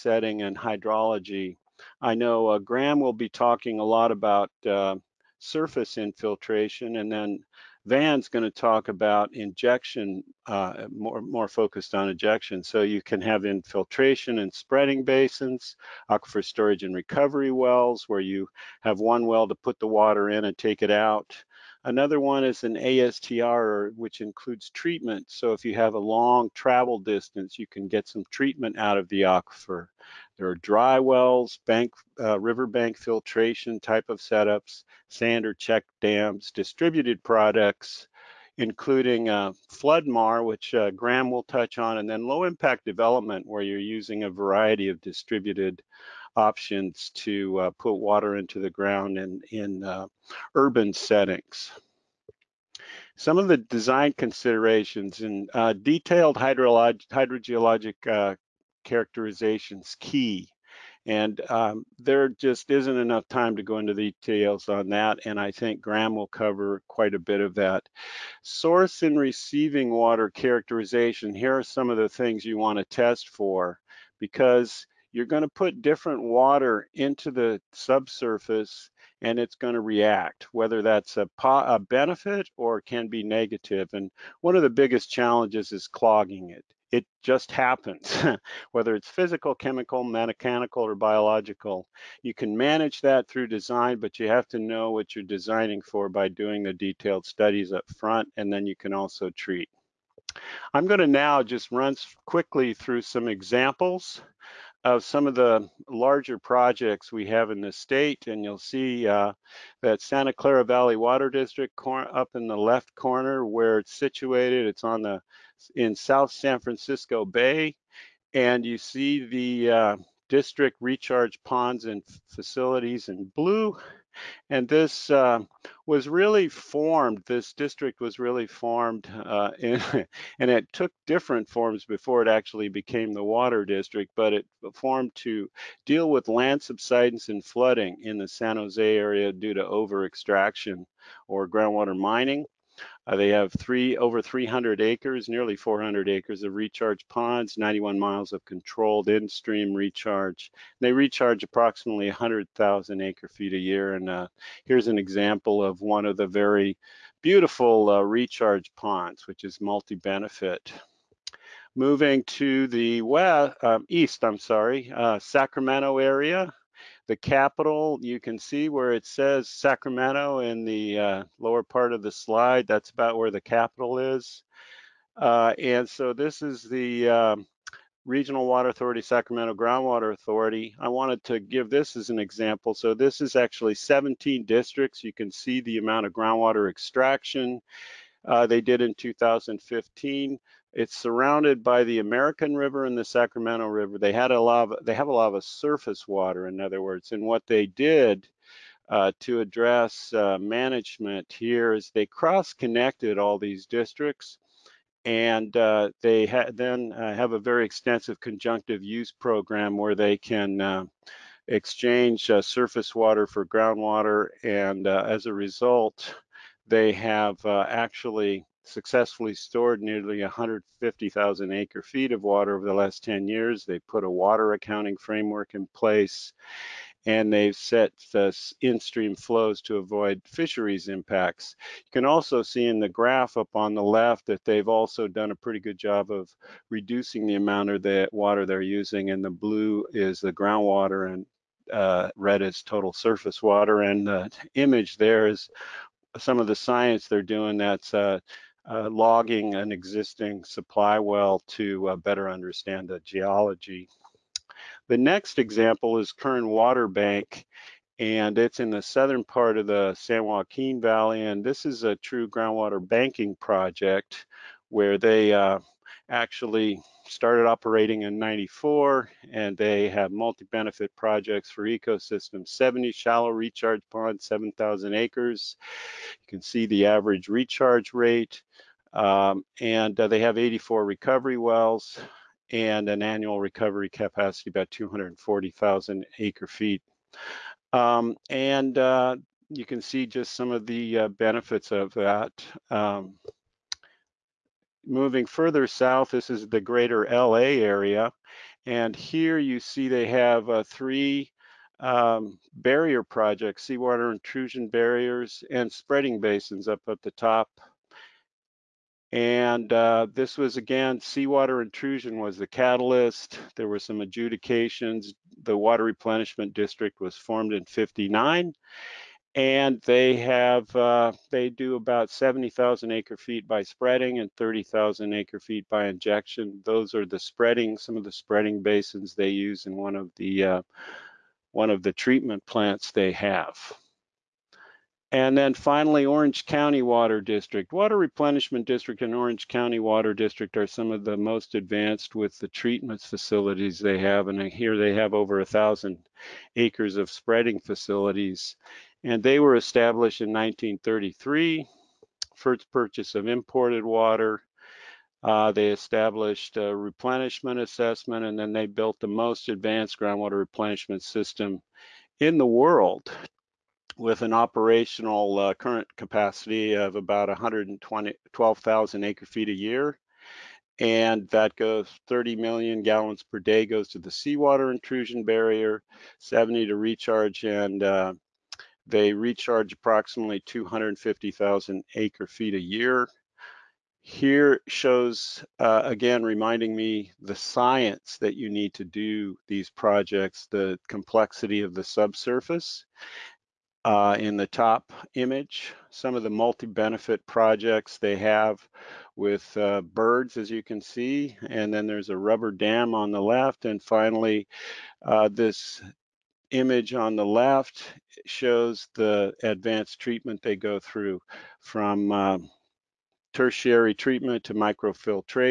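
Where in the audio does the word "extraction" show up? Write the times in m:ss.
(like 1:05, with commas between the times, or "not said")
2:20, 3:06.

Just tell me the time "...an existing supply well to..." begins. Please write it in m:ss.
4:09.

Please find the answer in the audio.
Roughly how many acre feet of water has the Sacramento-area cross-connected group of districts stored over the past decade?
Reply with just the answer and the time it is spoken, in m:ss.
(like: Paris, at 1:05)
150,000 acre feet, at 3:40.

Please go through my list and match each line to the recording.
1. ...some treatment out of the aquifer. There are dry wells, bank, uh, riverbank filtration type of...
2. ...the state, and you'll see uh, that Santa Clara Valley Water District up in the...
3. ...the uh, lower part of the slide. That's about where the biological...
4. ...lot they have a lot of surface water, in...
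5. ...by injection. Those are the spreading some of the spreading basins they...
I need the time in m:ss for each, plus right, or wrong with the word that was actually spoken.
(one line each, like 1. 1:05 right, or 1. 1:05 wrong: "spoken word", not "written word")
1. 0:28 right
2. 1:47 right
3. 2:50 wrong: "capital", not "biological"
4. 3:14 right
5. 5:25 right.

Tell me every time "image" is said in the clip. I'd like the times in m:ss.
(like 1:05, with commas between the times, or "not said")
4:04, 6:35, 6:46.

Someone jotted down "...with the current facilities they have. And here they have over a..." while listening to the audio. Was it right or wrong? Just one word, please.
wrong.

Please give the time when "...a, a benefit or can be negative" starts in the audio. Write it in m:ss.
1:21.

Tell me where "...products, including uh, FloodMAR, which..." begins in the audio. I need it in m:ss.
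0:37.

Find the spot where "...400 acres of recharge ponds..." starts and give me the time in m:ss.
2:25.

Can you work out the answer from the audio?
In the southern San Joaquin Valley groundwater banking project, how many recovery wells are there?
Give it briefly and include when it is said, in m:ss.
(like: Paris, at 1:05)
84, at 4:40.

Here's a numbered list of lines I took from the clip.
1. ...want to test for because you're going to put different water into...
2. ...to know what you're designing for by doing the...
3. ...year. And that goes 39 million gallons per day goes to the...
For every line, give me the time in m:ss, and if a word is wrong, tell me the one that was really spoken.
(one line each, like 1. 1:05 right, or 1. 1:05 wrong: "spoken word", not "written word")
1. 1:12 right
2. 1:34 right
3. 6:09 wrong: "30", not "39".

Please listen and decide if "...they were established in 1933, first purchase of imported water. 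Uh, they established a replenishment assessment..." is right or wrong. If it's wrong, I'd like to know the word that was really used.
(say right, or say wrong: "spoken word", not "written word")
right.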